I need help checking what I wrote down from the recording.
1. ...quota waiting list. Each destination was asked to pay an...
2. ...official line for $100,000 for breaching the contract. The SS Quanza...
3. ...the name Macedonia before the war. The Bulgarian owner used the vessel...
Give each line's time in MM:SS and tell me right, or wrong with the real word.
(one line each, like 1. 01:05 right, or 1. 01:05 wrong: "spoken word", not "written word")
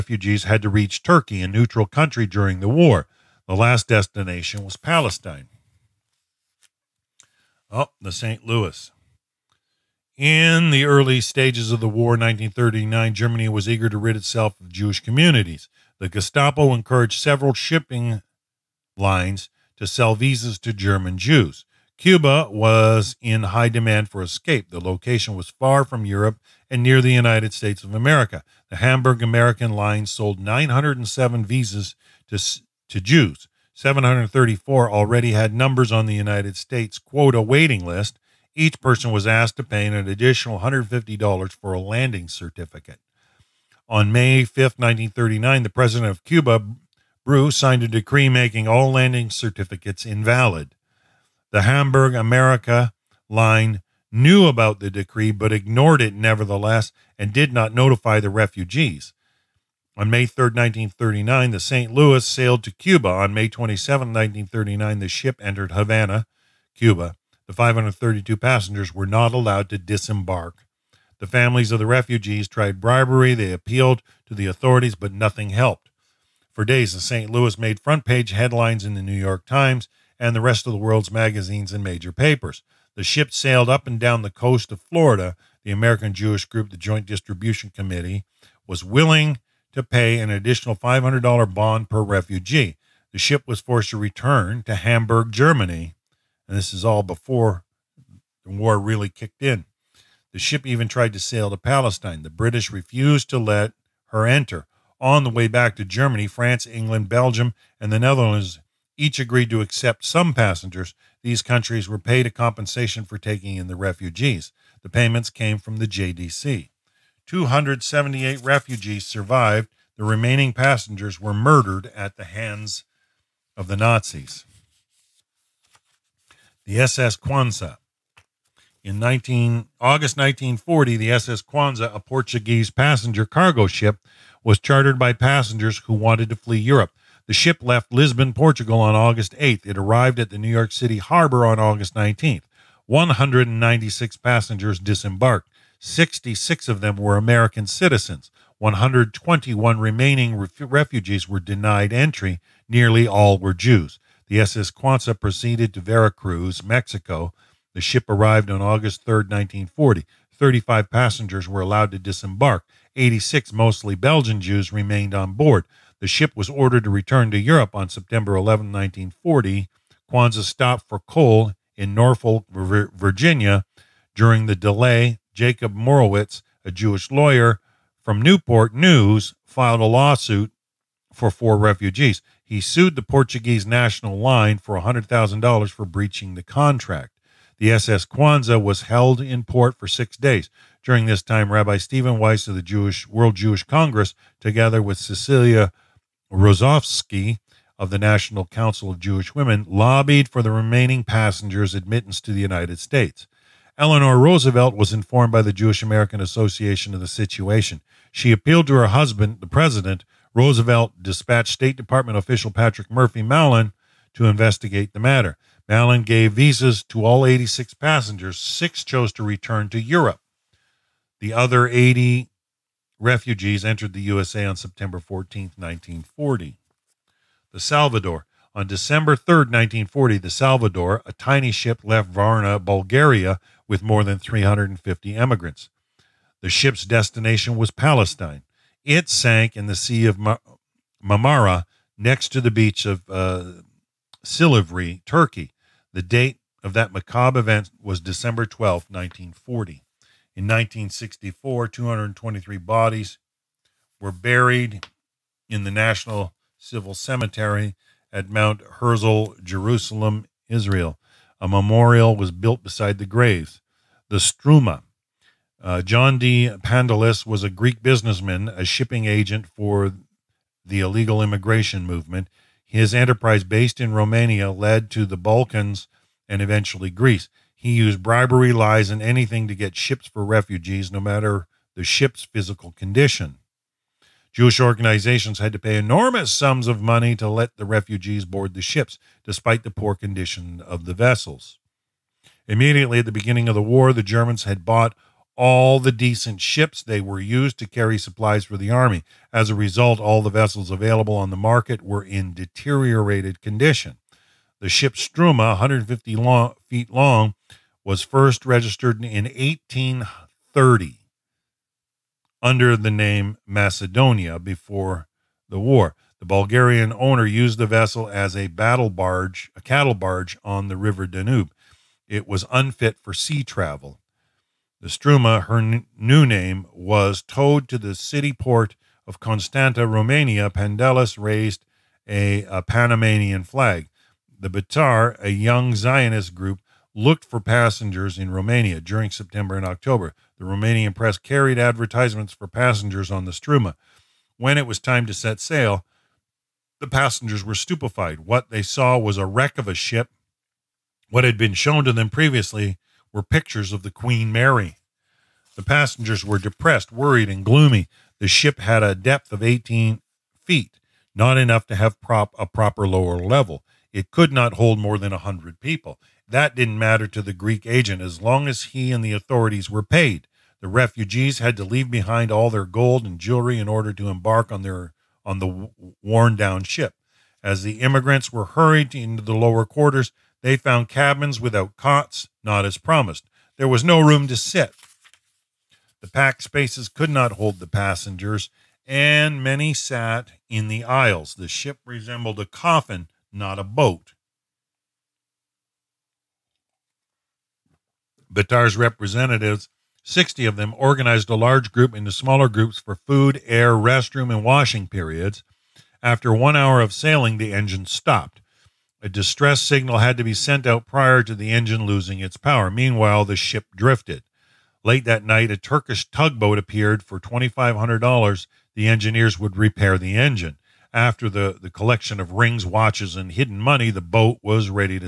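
1. 00:36 wrong: "person", not "destination"
2. 03:03 wrong: "national", not "official"
3. 05:12 right.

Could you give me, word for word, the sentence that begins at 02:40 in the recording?
35 passengers were allowed to disembark.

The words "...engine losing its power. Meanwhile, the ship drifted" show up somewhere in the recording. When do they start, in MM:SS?
06:51.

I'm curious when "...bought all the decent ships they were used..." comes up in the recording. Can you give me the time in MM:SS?
04:54.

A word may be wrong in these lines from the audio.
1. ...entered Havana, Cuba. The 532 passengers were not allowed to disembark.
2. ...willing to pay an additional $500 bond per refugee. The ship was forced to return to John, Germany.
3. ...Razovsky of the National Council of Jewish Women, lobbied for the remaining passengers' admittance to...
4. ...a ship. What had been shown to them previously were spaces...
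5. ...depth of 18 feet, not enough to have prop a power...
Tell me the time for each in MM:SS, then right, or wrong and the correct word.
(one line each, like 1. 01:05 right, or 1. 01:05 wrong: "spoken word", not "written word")
1. 01:05 right
2. 01:28 wrong: "Hamburg", not "John"
3. 03:16 right
4. 05:49 wrong: "pictures", not "spaces"
5. 05:58 wrong: "proper", not "power".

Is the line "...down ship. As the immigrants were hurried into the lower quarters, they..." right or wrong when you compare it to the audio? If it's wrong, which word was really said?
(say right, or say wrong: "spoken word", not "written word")
right.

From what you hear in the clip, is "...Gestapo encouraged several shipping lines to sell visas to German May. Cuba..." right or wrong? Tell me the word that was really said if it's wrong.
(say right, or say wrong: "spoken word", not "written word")
wrong: "Jews", not "May".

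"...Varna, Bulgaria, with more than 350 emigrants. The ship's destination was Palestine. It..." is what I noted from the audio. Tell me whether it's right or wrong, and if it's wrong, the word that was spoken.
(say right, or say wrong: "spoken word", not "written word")
right.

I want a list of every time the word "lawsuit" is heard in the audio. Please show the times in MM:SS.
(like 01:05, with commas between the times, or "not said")
02:59.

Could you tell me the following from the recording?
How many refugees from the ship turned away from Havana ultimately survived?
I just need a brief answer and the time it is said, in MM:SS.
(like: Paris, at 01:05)
278, at 01:57.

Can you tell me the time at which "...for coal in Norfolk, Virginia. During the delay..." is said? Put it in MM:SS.
02:50.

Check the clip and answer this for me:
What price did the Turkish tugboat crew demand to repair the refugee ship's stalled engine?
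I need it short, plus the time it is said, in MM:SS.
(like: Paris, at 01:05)
$2,500, at 06:57.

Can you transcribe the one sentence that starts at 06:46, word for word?
After one hour of sailing, the engine stopped.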